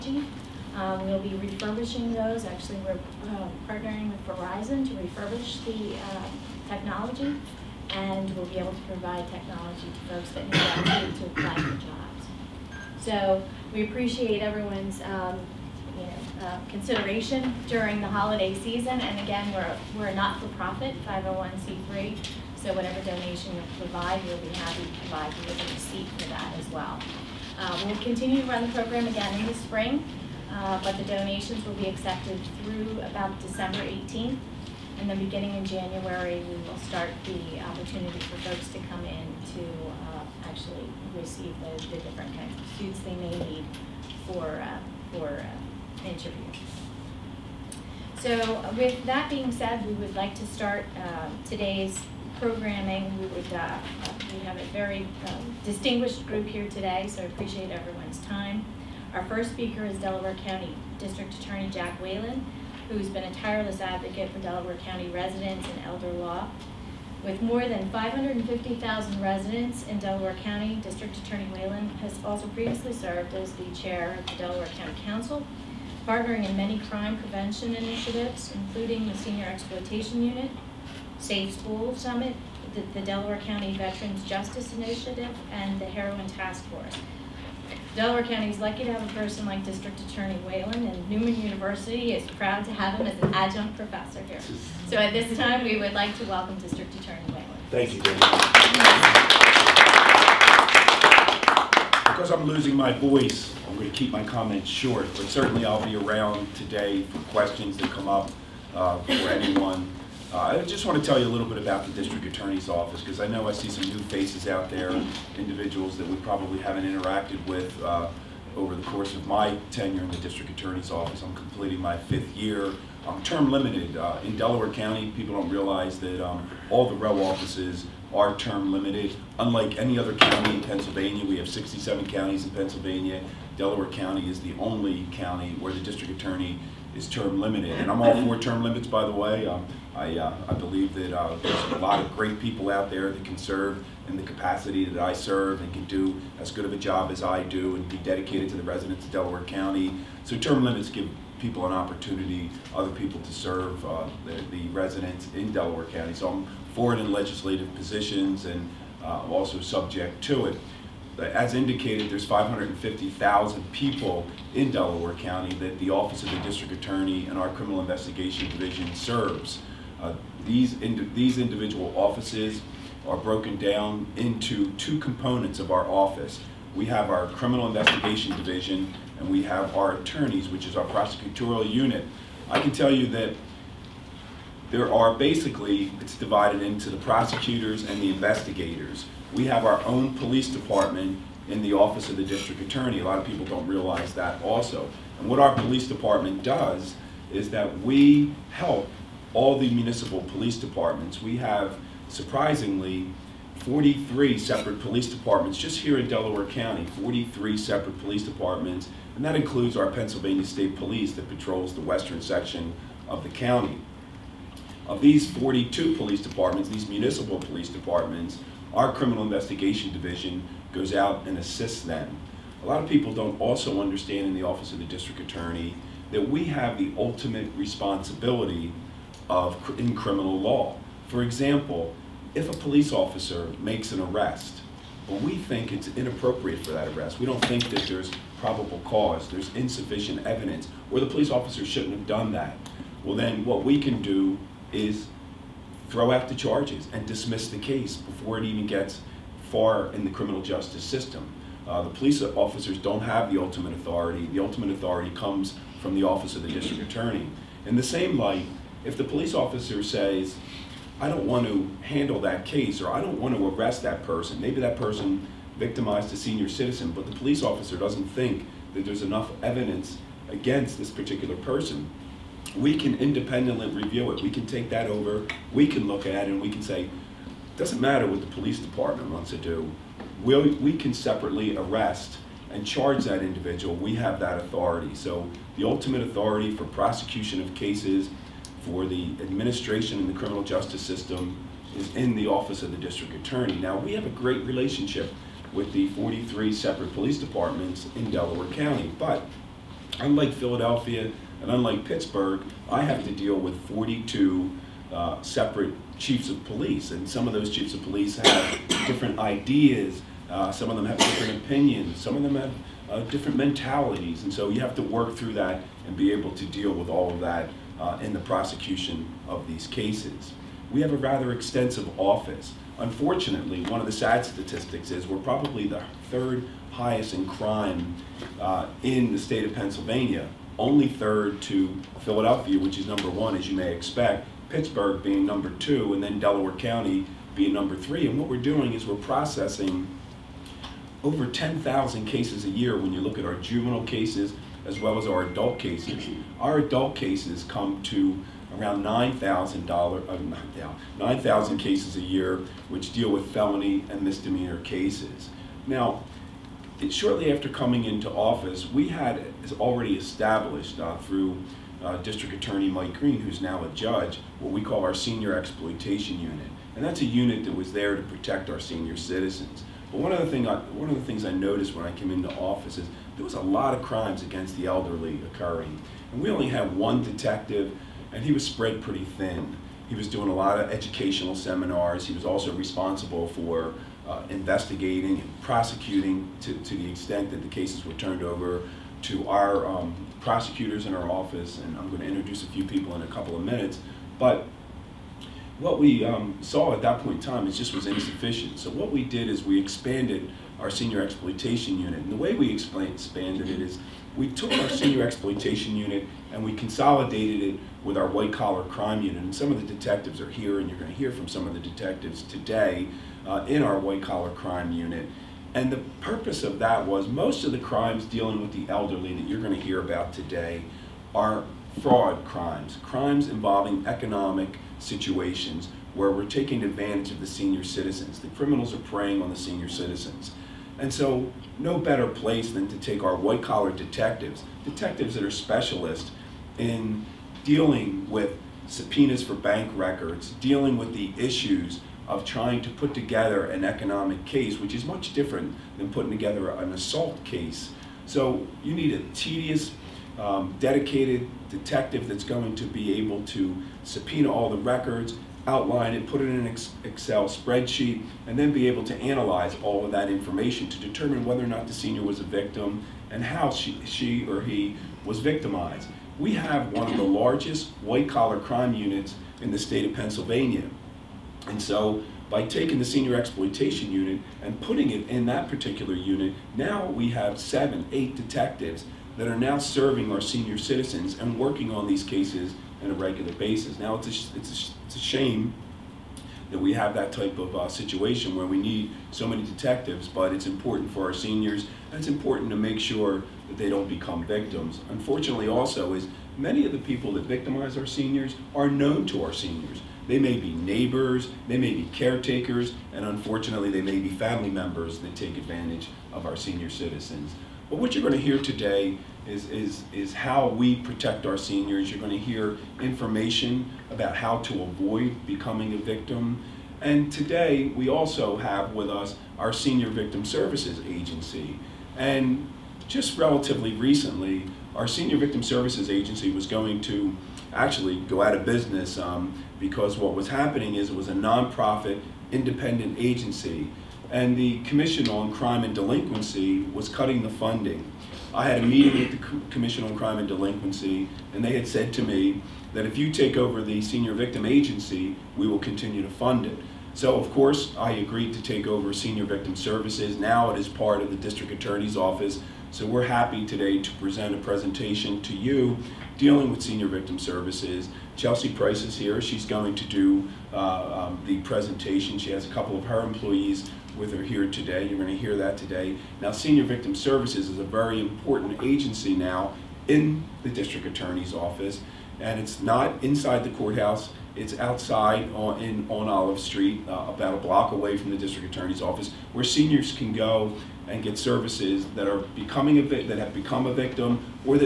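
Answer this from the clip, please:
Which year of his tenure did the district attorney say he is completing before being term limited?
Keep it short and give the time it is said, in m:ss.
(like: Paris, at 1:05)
fifth, at 2:01.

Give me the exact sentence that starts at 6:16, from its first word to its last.
And we only had one detective, and he was spread pretty thin.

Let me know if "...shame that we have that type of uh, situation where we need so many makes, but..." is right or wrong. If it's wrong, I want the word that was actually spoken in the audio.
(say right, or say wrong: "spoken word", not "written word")
wrong: "detectives", not "makes".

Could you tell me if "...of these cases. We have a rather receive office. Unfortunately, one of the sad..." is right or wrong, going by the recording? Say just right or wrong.
wrong.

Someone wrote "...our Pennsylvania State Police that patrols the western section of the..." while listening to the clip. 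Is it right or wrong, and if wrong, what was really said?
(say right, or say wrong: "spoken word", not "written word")
right.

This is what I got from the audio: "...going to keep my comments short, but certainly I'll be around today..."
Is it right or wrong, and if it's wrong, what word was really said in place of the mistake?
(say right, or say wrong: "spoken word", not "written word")
right.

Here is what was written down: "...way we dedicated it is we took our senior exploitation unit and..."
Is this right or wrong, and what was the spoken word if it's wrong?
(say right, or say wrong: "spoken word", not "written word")
wrong: "expanded", not "dedicated".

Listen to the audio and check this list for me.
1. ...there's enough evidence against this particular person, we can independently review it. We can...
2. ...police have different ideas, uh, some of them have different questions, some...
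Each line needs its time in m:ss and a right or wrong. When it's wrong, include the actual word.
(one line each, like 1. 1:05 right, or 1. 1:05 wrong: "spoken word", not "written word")
1. 4:28 right
2. 5:07 wrong: "opinions", not "questions".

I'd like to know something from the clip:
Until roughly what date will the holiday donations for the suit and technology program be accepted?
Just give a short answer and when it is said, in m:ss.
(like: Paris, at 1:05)
December 18th, at 0:33.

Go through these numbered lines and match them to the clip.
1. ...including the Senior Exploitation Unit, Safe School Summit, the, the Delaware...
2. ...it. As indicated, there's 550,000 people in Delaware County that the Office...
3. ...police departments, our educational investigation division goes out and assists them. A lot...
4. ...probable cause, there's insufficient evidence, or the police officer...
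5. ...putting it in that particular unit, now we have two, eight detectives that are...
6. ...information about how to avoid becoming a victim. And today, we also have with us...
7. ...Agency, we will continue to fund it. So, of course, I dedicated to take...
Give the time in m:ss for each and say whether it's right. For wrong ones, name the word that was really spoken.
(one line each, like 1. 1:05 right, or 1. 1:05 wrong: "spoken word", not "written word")
1. 1:18 right
2. 2:40 right
3. 3:37 wrong: "criminal", not "educational"
4. 3:58 right
5. 7:54 wrong: "seven", not "two"
6. 8:32 right
7. 9:04 wrong: "agreed", not "dedicated".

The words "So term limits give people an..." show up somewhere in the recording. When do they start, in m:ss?
2:30.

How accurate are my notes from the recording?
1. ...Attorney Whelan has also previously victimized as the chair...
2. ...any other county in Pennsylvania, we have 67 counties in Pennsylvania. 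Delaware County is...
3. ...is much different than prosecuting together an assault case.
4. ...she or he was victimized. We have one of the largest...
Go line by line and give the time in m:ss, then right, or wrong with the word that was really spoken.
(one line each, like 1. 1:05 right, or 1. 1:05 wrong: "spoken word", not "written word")
1. 1:11 wrong: "served", not "victimized"
2. 2:09 right
3. 7:24 wrong: "putting", not "prosecuting"
4. 7:43 right.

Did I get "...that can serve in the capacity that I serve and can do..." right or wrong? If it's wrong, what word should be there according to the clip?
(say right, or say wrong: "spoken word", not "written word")
right.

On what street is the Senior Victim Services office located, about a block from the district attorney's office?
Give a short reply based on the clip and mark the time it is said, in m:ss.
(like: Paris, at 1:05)
Olive Street, at 9:36.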